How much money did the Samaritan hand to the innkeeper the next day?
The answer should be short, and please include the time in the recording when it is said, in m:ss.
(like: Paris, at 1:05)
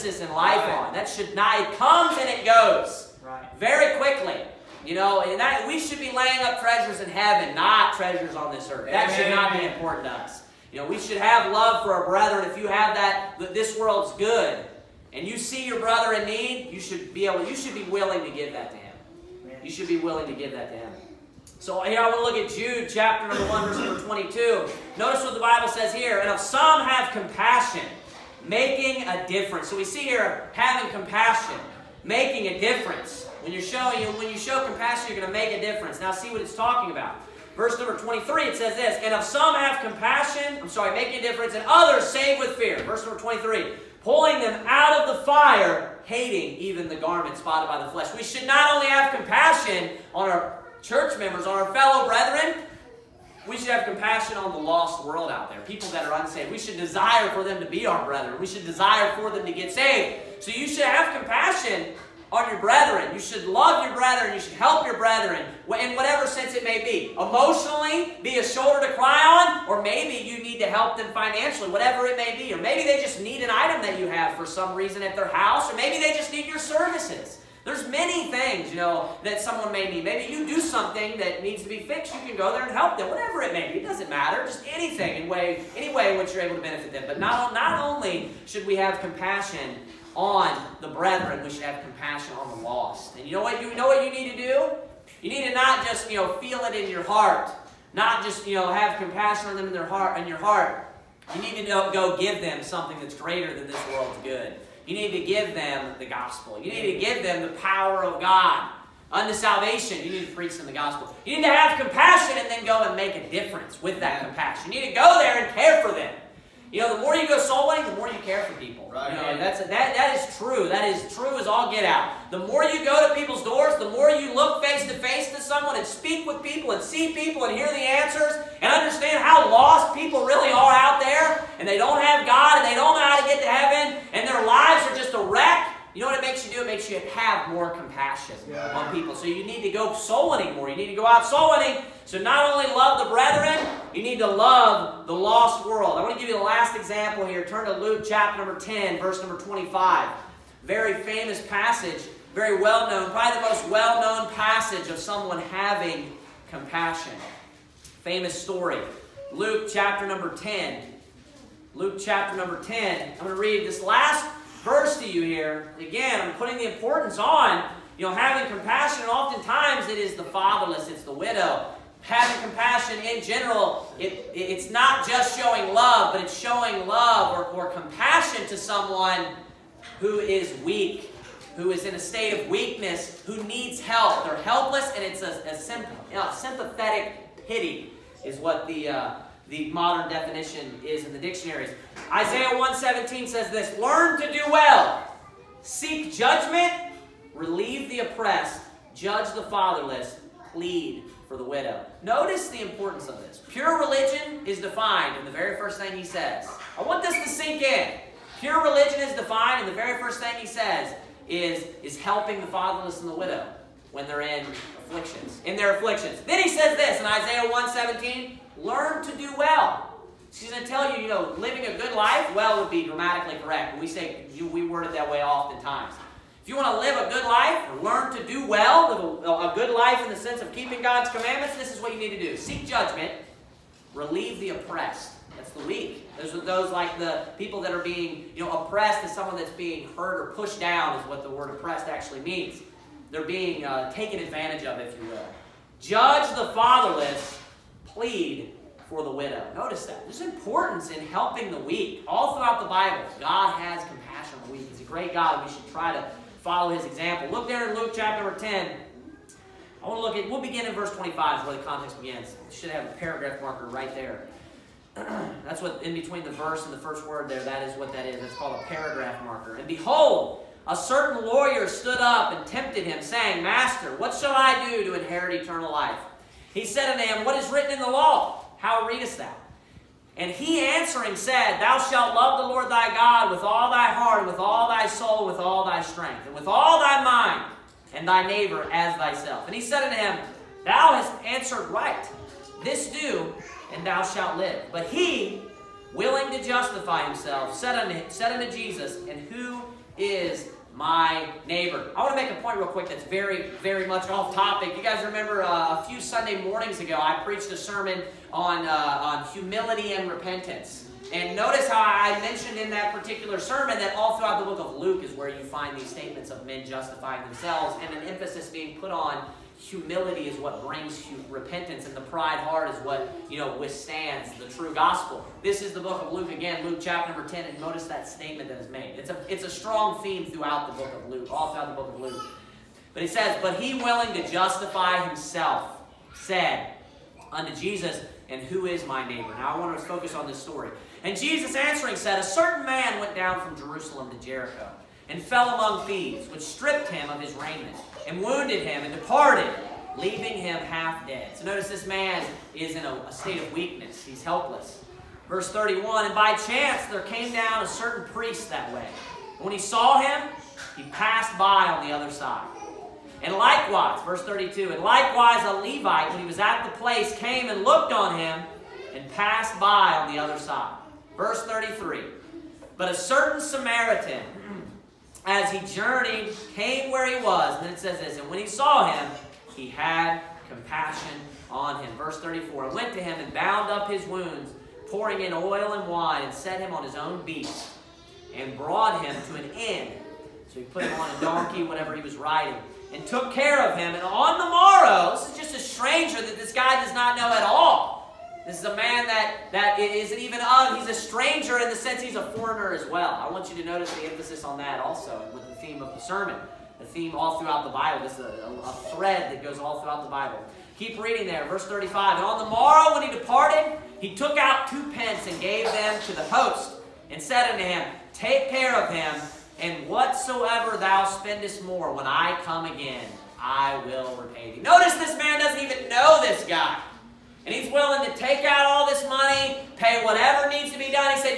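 Two pence, at 6:54.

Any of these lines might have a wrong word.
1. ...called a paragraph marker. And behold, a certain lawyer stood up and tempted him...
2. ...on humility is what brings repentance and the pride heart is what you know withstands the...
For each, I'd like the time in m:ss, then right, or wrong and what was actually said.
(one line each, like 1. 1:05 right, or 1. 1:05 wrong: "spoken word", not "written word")
1. 4:28 right
2. 5:18 right.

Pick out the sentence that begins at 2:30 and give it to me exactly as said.
Very famous passage, very well known, probably the most well known passage of someone having compassion.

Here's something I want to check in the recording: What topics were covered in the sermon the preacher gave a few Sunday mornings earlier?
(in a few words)
Humility and repentance.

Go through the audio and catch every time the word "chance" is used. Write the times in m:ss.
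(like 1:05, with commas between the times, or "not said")
5:56.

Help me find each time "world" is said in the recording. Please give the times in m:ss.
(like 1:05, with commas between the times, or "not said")
0:13, 0:55, 1:43, 2:25.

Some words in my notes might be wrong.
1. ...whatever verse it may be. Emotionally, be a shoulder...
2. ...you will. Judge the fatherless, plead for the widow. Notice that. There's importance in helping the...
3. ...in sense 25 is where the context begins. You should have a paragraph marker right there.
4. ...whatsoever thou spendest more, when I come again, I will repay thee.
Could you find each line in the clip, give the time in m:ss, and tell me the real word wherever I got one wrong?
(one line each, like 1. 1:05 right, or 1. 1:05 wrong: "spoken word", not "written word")
1. 1:05 wrong: "sense", not "verse"
2. 4:05 right
3. 4:20 wrong: "verse", not "sense"
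4. 6:59 right.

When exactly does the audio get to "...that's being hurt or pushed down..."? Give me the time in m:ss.
3:59.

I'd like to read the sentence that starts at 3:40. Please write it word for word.
She's going to tell you, you know, living a good life, well would be grammatically correct.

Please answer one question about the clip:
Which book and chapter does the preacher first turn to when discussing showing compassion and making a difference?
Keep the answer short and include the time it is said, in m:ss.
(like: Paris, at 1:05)
Jude chapter 1, at 0:22.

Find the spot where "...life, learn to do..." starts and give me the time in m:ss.
3:47.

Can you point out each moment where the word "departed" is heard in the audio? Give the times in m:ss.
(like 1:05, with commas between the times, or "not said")
5:48, 6:53.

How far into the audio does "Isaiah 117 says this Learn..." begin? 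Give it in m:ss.
3:12.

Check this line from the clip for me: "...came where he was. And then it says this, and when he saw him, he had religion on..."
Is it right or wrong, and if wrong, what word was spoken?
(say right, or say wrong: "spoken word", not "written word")
wrong: "compassion", not "religion".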